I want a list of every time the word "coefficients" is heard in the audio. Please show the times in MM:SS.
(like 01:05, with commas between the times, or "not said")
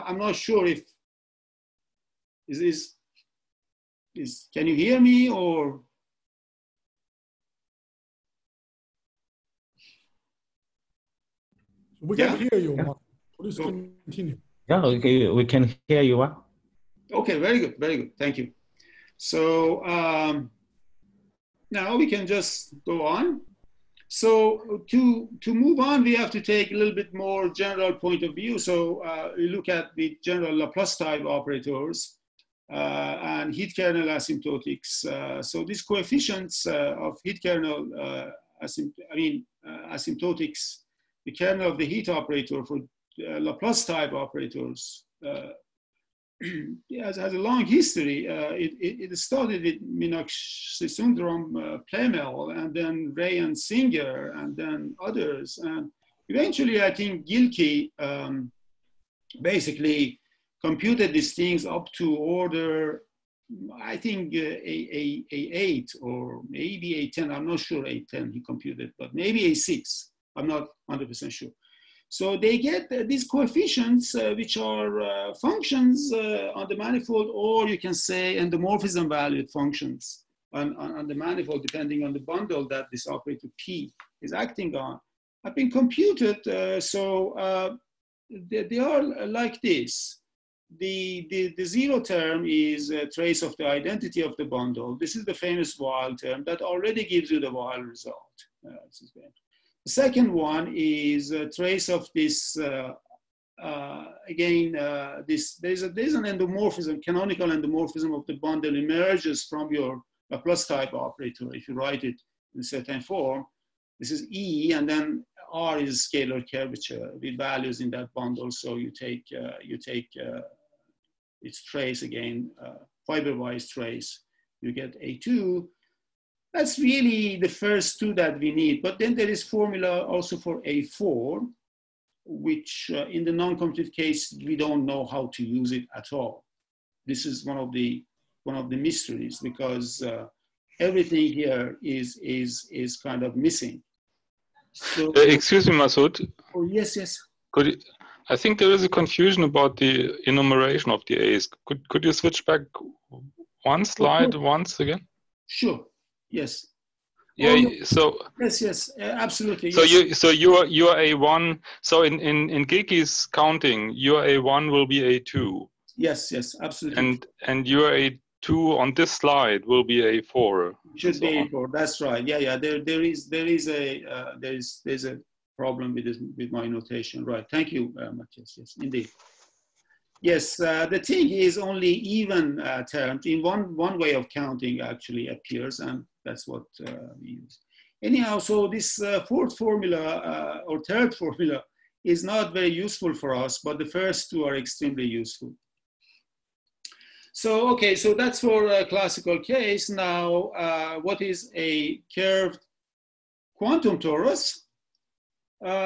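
00:35, 01:13.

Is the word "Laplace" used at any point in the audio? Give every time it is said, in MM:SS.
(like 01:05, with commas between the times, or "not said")
00:30, 00:43.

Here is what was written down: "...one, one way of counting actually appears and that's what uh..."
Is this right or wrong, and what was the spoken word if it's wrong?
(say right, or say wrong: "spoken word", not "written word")
right.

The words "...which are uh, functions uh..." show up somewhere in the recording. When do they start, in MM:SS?
01:14.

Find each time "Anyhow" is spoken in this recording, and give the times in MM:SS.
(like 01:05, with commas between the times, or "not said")
03:08.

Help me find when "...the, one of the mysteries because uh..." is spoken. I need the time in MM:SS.
02:17.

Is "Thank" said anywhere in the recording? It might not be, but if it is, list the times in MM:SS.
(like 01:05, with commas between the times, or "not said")
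00:18, 02:57.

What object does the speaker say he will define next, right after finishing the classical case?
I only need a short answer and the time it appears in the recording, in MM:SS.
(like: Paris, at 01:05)
curved quantum torus, at 03:22.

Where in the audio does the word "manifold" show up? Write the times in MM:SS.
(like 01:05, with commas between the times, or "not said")
01:16, 01:21.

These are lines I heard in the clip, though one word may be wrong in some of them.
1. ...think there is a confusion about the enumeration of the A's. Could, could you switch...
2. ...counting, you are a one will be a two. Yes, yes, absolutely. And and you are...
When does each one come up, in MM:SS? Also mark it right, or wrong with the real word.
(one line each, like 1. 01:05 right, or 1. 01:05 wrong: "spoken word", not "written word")
1. 02:28 right
2. 02:43 right.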